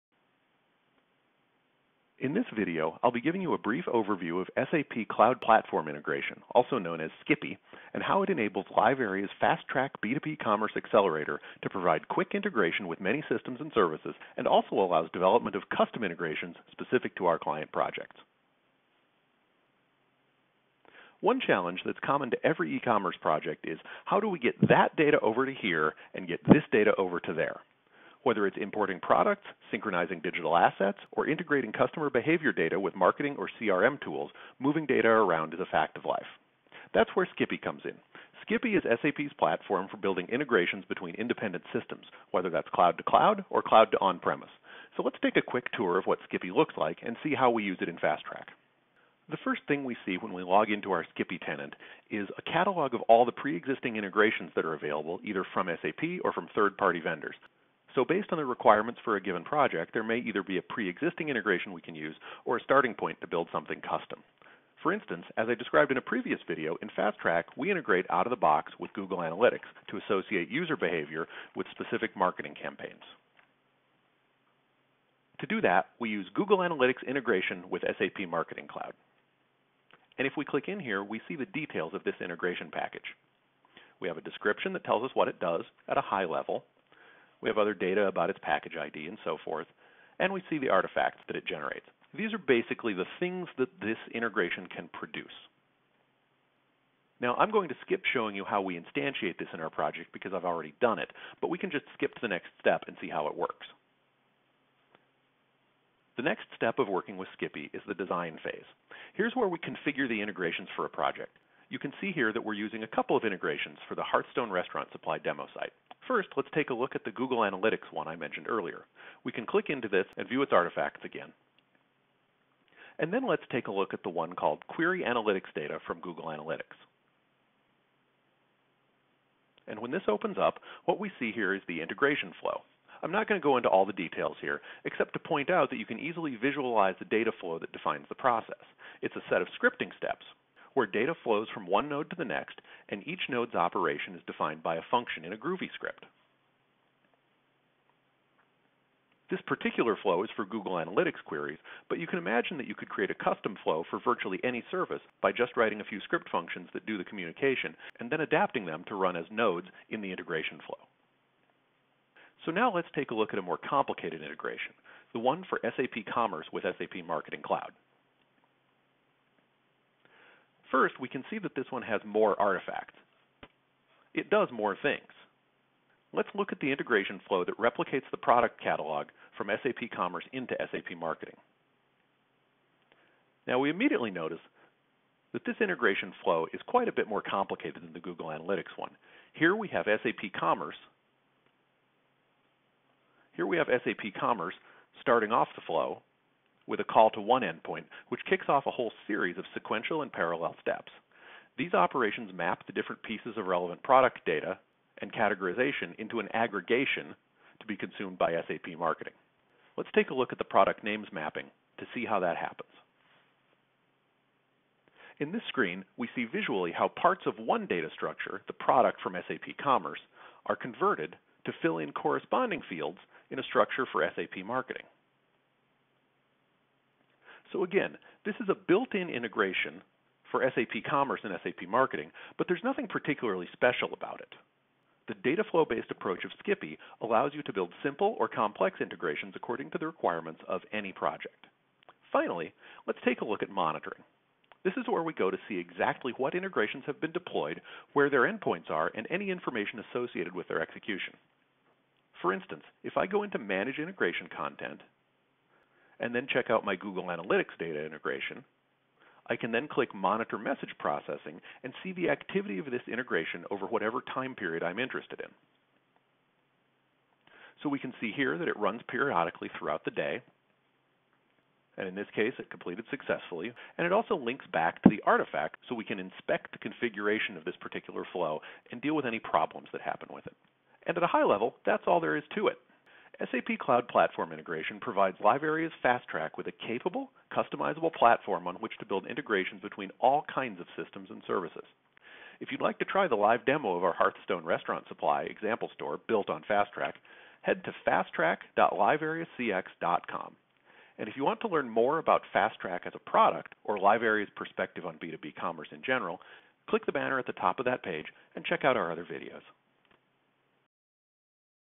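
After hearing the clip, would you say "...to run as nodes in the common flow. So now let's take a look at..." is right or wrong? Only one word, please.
wrong.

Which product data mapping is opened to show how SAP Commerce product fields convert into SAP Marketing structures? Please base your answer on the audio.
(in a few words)
product names mapping.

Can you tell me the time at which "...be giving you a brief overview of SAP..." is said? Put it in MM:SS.
00:03.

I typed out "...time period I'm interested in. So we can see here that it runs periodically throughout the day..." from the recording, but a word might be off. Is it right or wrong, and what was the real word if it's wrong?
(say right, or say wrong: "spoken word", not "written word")
right.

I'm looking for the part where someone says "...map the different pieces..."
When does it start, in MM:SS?
03:22.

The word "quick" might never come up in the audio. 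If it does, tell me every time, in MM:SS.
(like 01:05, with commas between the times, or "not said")
00:12, 00:45.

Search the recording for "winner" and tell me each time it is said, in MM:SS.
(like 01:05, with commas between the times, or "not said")
not said.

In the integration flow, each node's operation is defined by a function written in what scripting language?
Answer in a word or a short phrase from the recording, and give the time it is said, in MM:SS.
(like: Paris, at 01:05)
Groovy, at 02:25.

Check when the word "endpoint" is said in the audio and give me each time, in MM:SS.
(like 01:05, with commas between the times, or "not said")
03:17, 04:08.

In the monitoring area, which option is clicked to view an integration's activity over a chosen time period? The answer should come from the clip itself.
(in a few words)
Monitor Message Processing.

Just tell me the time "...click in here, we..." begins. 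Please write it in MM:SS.
01:20.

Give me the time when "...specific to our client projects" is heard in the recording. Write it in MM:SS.
00:16.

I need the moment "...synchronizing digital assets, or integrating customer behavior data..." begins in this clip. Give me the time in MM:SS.
00:29.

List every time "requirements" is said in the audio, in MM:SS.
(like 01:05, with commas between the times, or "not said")
00:58, 03:59.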